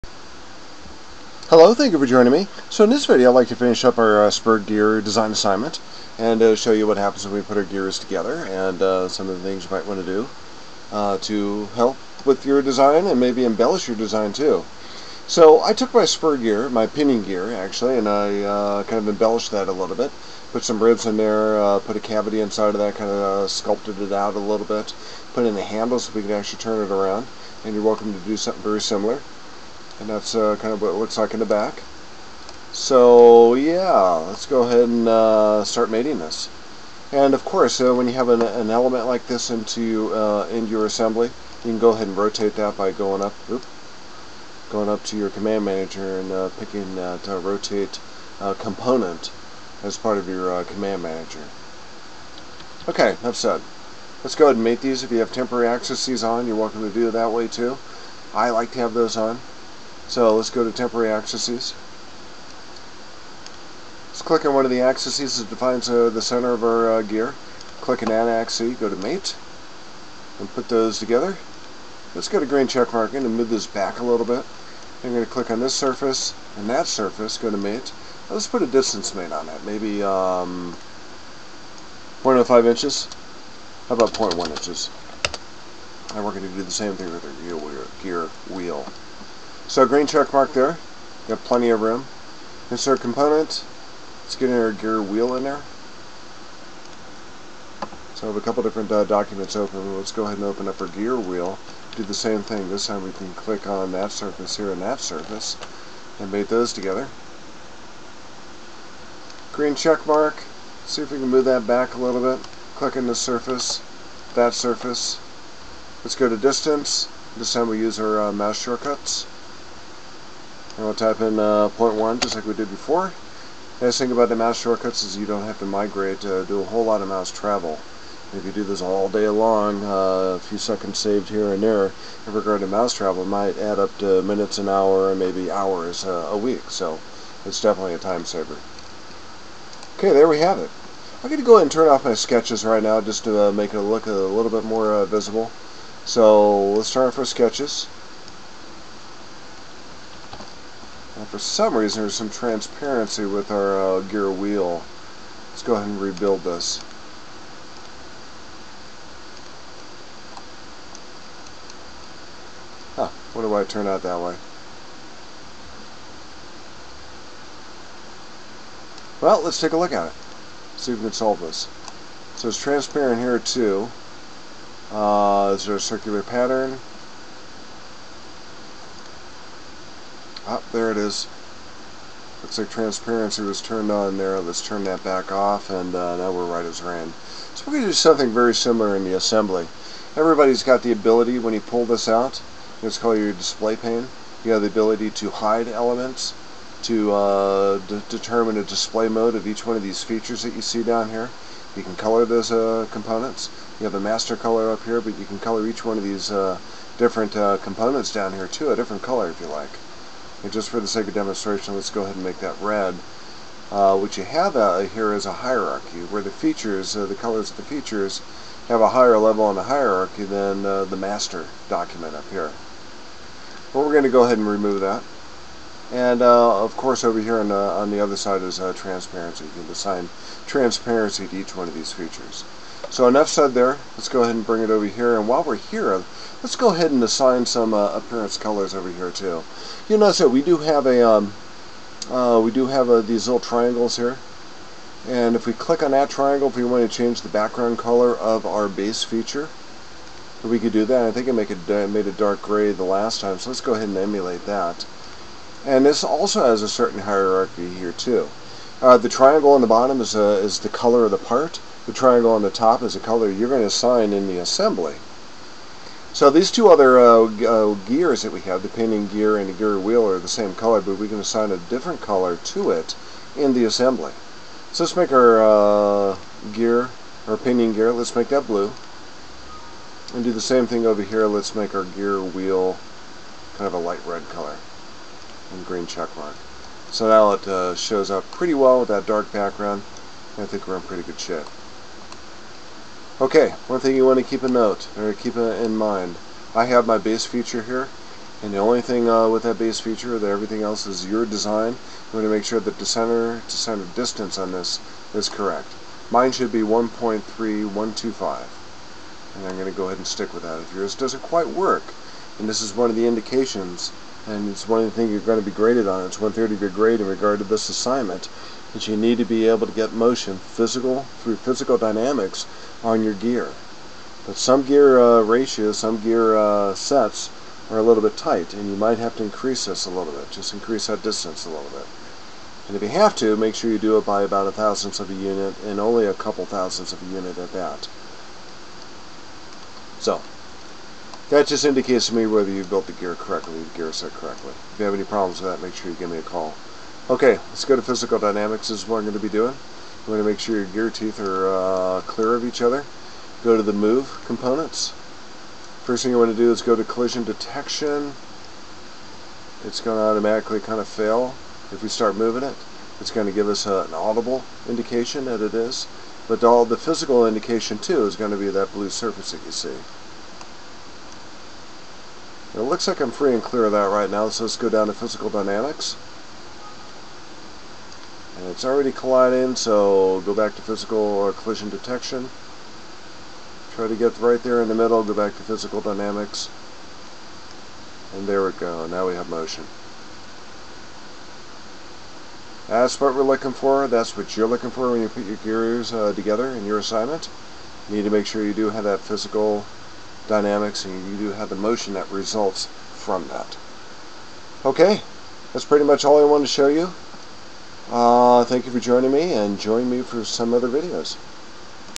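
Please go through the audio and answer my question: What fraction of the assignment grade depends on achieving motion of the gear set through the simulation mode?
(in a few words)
one third.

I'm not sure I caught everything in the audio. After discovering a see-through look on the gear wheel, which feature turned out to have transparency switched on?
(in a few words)
circular pattern.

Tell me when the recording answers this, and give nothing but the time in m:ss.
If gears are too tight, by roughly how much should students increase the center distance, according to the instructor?
5:34.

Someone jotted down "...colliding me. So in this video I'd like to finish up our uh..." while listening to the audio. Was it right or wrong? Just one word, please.
wrong.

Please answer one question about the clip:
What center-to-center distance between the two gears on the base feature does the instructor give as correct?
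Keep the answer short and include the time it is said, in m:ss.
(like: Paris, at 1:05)
1.3125, at 5:06.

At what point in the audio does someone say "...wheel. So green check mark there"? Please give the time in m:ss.
1:28.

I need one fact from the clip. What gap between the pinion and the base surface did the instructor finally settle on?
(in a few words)
0.1 inches.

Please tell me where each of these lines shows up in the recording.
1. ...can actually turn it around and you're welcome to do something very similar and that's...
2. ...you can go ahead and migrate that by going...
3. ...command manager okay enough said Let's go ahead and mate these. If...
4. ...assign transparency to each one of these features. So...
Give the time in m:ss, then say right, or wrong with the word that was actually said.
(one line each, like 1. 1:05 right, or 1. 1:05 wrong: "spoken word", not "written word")
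1. 0:26 right
2. 0:41 wrong: "rotate", not "migrate"
3. 0:50 right
4. 3:49 right.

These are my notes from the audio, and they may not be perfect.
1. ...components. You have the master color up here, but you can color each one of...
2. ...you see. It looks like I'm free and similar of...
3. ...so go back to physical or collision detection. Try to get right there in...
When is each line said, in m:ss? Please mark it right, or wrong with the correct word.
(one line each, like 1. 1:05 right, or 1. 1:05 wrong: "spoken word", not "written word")
1. 3:22 right
2. 6:09 wrong: "clear", not "similar"
3. 6:19 right.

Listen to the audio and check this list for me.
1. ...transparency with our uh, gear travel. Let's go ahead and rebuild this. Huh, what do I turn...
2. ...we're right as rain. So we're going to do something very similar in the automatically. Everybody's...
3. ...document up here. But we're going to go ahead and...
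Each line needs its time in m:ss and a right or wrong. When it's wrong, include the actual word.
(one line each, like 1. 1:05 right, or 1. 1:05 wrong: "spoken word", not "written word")
1. 2:32 wrong: "wheel", not "travel"
2. 3:06 wrong: "assembly", not "automatically"
3. 3:41 right.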